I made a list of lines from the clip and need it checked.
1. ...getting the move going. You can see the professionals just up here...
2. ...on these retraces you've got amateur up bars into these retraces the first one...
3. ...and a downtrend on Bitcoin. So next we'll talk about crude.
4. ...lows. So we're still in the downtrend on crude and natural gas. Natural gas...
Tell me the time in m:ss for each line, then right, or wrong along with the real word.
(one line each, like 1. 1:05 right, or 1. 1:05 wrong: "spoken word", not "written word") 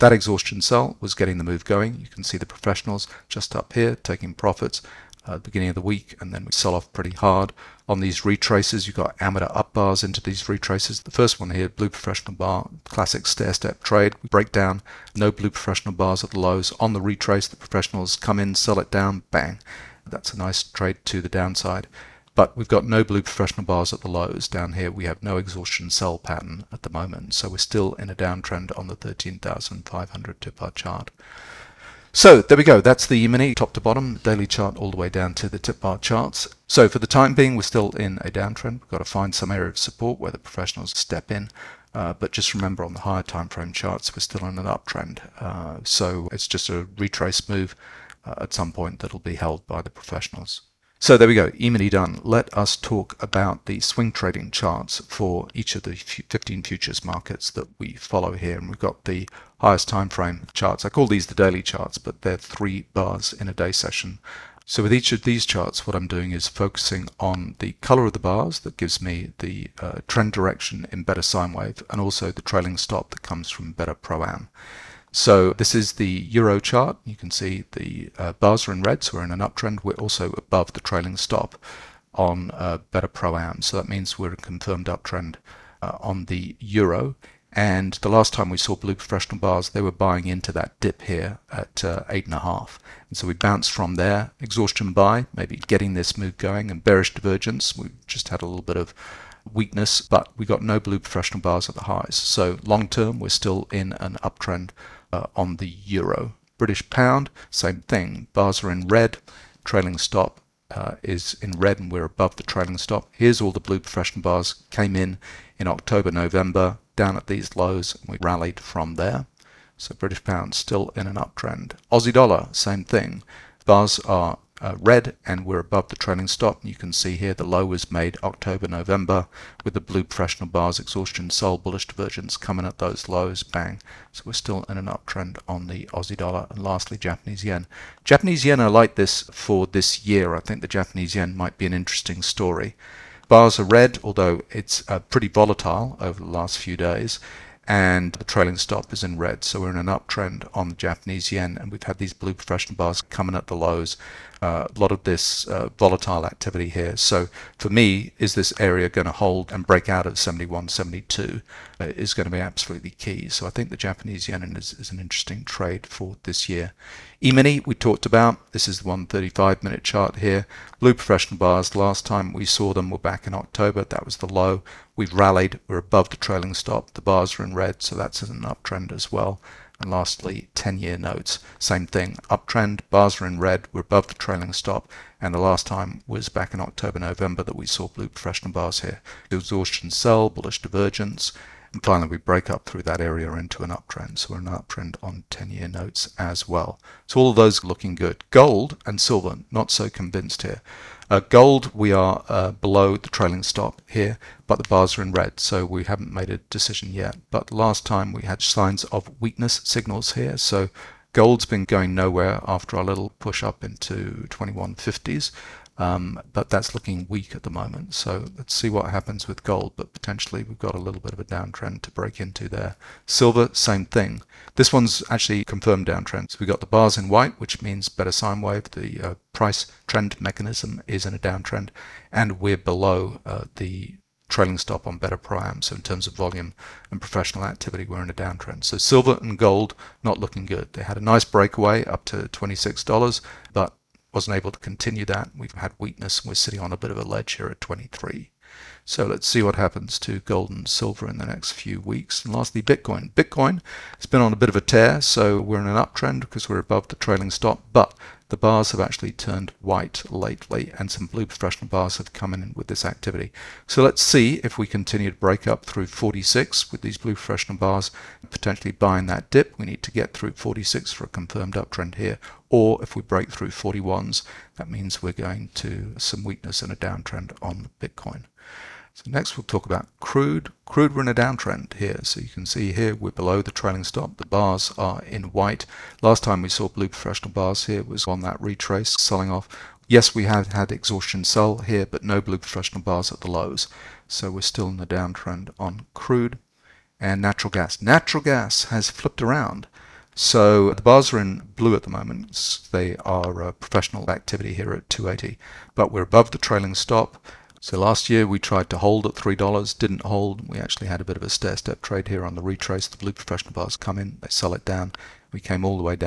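1. 0:01 right
2. 0:07 right
3. 4:36 right
4. 4:53 right.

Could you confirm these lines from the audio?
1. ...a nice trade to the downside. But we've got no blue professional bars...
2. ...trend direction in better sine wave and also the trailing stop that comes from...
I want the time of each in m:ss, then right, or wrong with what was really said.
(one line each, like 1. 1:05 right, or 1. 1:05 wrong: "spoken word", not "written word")
1. 0:20 right
2. 1:10 right.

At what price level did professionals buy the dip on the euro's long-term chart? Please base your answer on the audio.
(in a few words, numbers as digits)
8 and a half.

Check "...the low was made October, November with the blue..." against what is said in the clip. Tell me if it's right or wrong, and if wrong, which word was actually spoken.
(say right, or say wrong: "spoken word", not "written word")
right.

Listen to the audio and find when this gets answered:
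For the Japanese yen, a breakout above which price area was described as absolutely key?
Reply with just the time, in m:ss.
2:40.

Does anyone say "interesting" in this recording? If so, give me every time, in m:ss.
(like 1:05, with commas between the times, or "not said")
2:21, 2:44.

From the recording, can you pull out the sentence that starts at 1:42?
So long term, we're still in an uptrend uh, on the euro.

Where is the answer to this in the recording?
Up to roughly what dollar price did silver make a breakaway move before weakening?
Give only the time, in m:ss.
4:02.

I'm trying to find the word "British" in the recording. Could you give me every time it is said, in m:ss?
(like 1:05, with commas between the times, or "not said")
1:46, 1:59.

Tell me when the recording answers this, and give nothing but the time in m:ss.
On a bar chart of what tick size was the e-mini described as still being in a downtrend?
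0:28.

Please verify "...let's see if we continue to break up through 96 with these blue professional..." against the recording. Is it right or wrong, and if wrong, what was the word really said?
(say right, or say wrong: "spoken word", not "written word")
wrong: "46", not "96".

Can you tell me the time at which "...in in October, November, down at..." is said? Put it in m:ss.
1:54.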